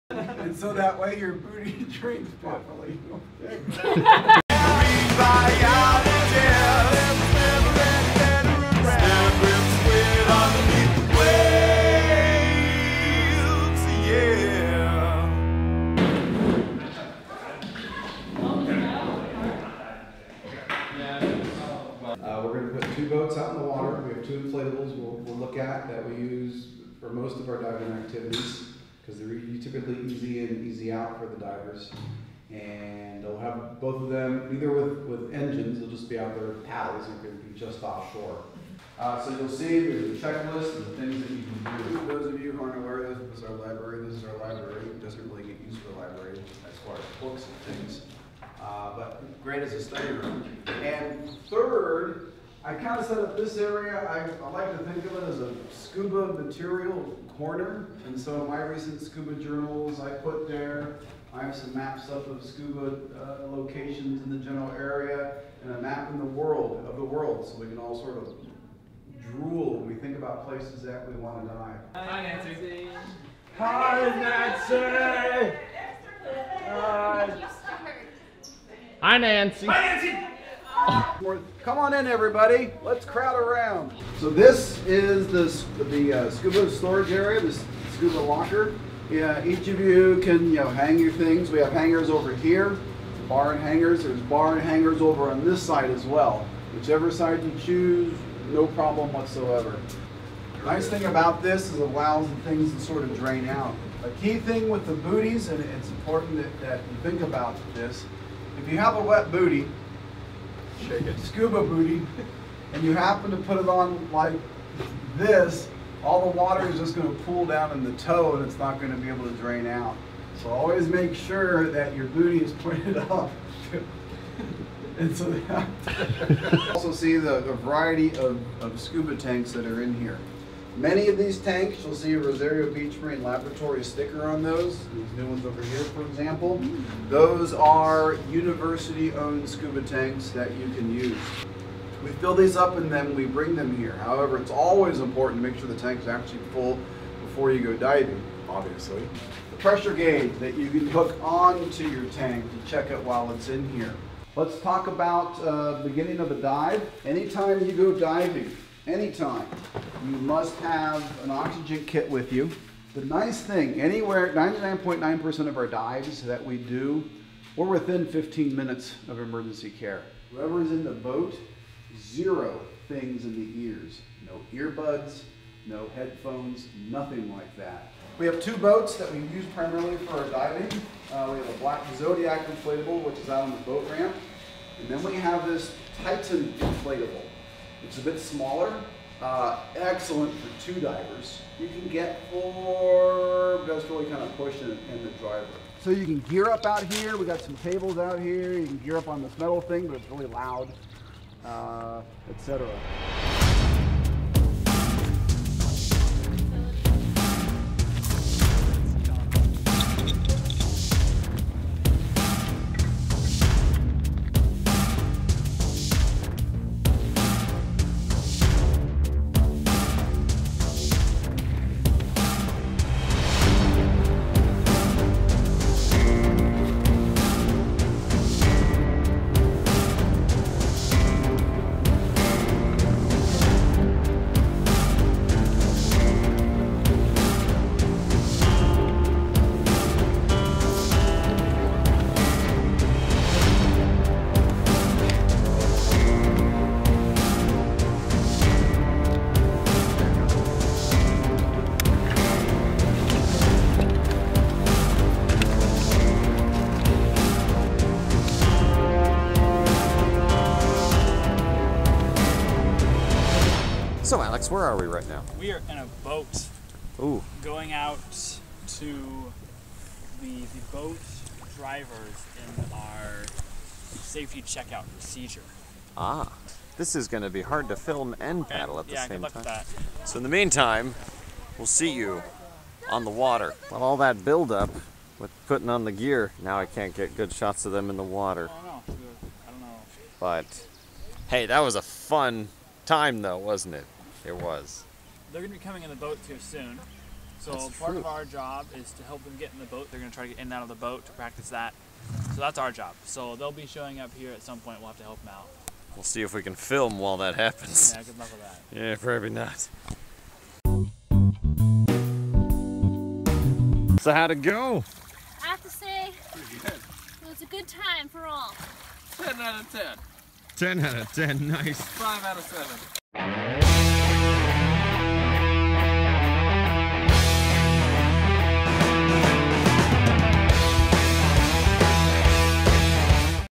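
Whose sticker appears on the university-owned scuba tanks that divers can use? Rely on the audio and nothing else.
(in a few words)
Rosario Beach Marine Laboratory.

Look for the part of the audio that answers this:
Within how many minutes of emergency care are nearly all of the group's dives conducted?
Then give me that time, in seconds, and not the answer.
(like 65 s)
168 s.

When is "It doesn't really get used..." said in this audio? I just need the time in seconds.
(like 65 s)
44 s.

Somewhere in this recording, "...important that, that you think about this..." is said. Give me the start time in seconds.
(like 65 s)
105 s.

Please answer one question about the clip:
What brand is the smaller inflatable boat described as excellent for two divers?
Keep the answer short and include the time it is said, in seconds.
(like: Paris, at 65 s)
Titan, at 186 s.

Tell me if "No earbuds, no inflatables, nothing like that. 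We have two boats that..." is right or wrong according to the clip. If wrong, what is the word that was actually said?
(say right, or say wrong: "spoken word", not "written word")
wrong: "headphones", not "inflatables".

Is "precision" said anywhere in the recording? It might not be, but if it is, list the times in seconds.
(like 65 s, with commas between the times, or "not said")
not said.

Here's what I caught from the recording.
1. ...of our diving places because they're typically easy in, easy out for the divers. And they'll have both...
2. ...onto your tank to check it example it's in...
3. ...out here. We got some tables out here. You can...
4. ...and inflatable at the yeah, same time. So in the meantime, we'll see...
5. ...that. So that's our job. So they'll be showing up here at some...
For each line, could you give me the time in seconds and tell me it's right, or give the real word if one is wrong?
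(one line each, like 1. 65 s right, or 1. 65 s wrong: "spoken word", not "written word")
1. 27 s wrong: "activities", not "places"
2. 151 s wrong: "while", not "example"
3. 196 s right
4. 278 s wrong: "paddle", not "inflatable"
5. 301 s right.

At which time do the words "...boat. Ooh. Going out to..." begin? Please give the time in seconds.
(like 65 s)
266 s.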